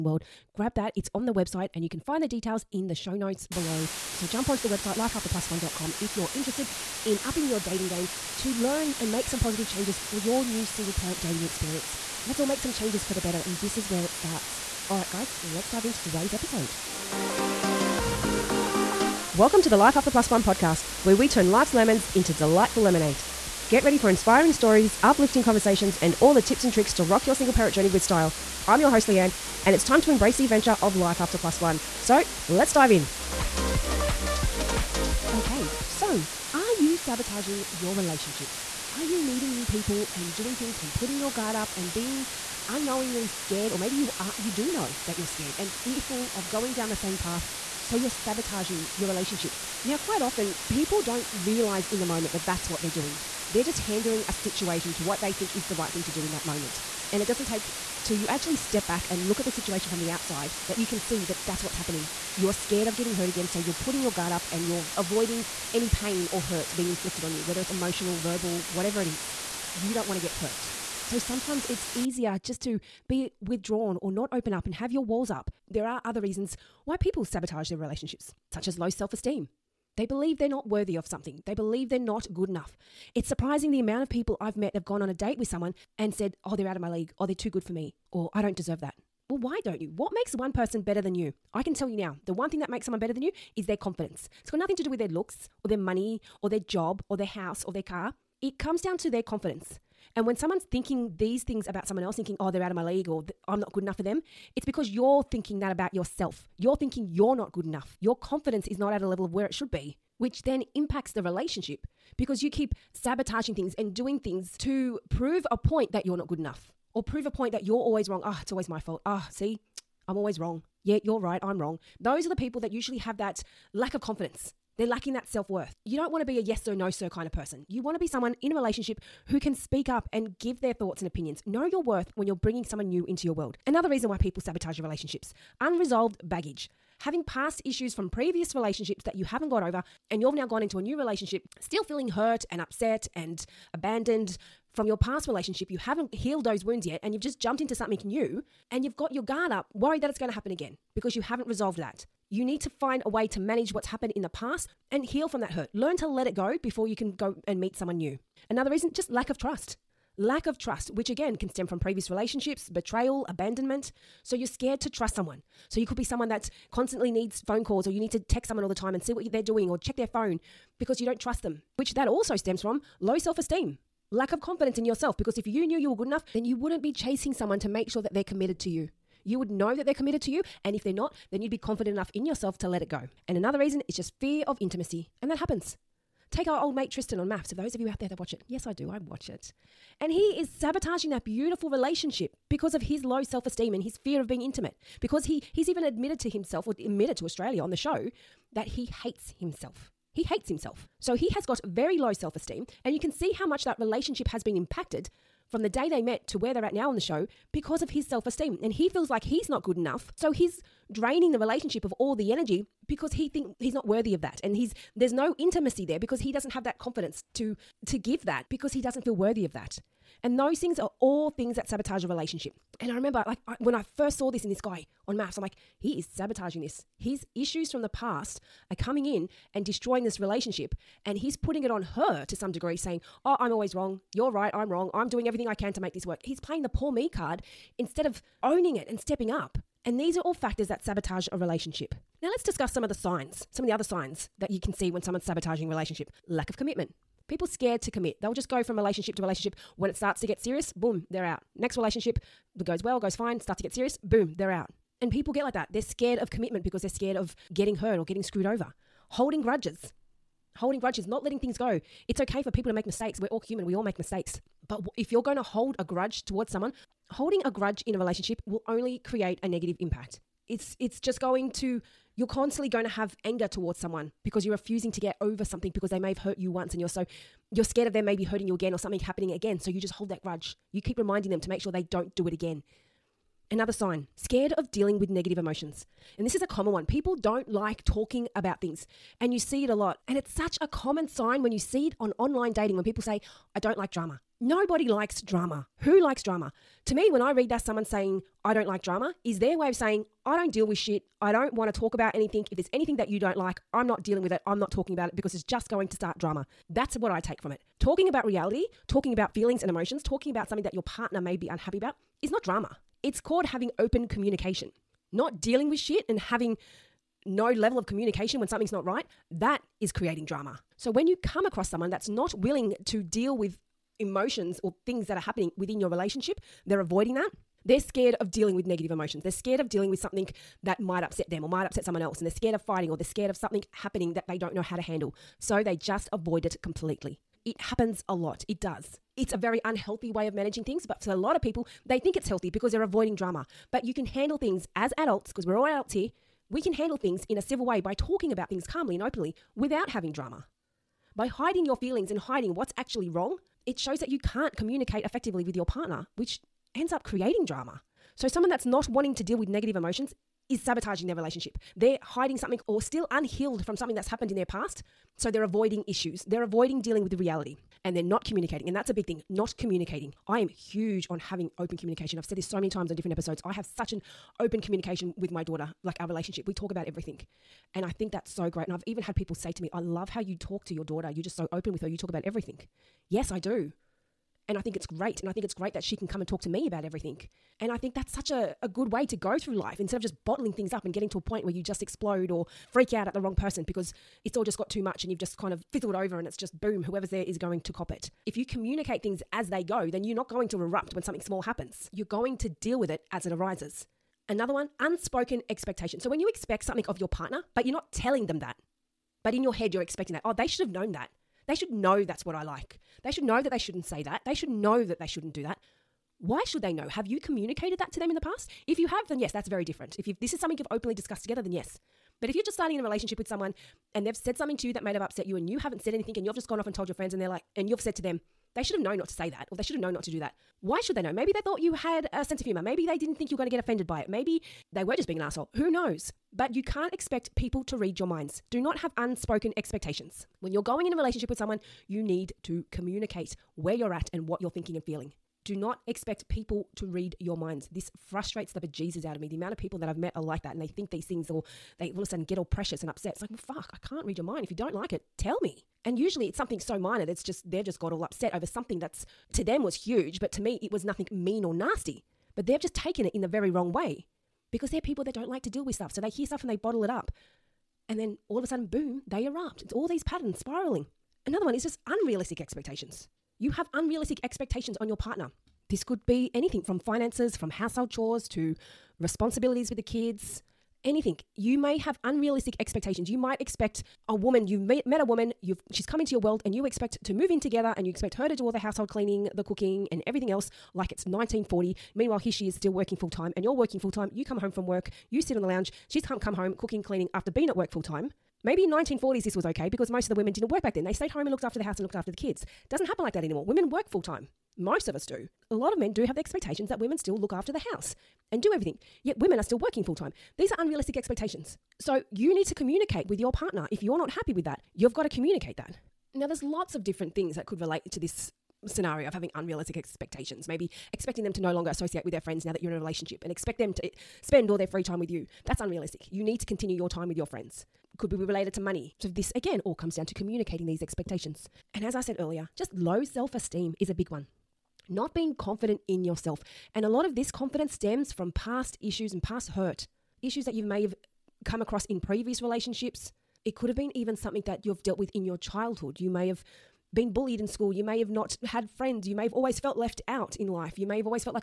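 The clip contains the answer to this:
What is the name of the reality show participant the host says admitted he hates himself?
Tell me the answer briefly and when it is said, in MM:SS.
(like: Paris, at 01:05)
Tristan, at 03:06.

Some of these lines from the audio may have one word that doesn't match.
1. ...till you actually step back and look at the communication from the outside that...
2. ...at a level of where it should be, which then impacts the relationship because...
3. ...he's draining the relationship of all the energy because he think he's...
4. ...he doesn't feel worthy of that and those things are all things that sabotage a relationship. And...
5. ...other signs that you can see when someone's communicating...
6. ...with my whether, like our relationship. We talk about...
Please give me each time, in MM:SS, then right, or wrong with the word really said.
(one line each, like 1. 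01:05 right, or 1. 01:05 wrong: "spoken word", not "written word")
1. 00:58 wrong: "situation", not "communication"
2. 01:48 right
3. 03:30 right
4. 03:38 right
5. 04:03 wrong: "sabotaging", not "communicating"
6. 06:15 wrong: "daughter", not "whether".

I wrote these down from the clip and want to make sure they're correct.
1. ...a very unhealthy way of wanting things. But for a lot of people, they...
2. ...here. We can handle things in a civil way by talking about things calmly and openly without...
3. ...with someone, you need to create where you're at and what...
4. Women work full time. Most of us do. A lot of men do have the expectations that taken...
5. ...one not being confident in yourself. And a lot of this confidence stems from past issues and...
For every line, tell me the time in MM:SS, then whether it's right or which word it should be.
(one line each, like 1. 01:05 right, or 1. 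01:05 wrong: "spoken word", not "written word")
1. 05:39 wrong: "managing", not "wanting"
2. 05:45 right
3. 07:21 wrong: "communicate", not "create"
4. 08:23 wrong: "women", not "taken"
5. 08:54 right.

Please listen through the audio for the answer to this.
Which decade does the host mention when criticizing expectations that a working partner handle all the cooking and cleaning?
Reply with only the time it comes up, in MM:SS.
08:11.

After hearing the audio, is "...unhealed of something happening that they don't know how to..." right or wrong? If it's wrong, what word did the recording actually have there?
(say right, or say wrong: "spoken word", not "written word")
wrong: "scared", not "unhealed".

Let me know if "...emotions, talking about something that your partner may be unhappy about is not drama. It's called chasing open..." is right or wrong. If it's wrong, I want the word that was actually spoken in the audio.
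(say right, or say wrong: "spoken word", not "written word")
wrong: "having", not "chasing".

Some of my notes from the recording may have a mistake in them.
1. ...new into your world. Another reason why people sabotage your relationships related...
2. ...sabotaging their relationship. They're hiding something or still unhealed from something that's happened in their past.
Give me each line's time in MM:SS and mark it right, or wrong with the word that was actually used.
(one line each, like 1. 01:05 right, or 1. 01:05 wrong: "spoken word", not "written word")
1. 02:12 wrong: "unresolved", not "related"
2. 06:00 right.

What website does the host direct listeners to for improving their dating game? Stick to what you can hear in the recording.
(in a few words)
lifeafterplus1.com.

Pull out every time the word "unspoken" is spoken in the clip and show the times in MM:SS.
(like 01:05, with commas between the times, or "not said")
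06:44, 07:18.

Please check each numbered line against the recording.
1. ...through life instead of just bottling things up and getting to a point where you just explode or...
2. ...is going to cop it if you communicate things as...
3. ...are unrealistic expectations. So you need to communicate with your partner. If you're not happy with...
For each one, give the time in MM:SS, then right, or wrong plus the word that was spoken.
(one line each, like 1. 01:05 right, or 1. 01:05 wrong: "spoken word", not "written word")
1. 06:29 right
2. 06:37 right
3. 08:30 right.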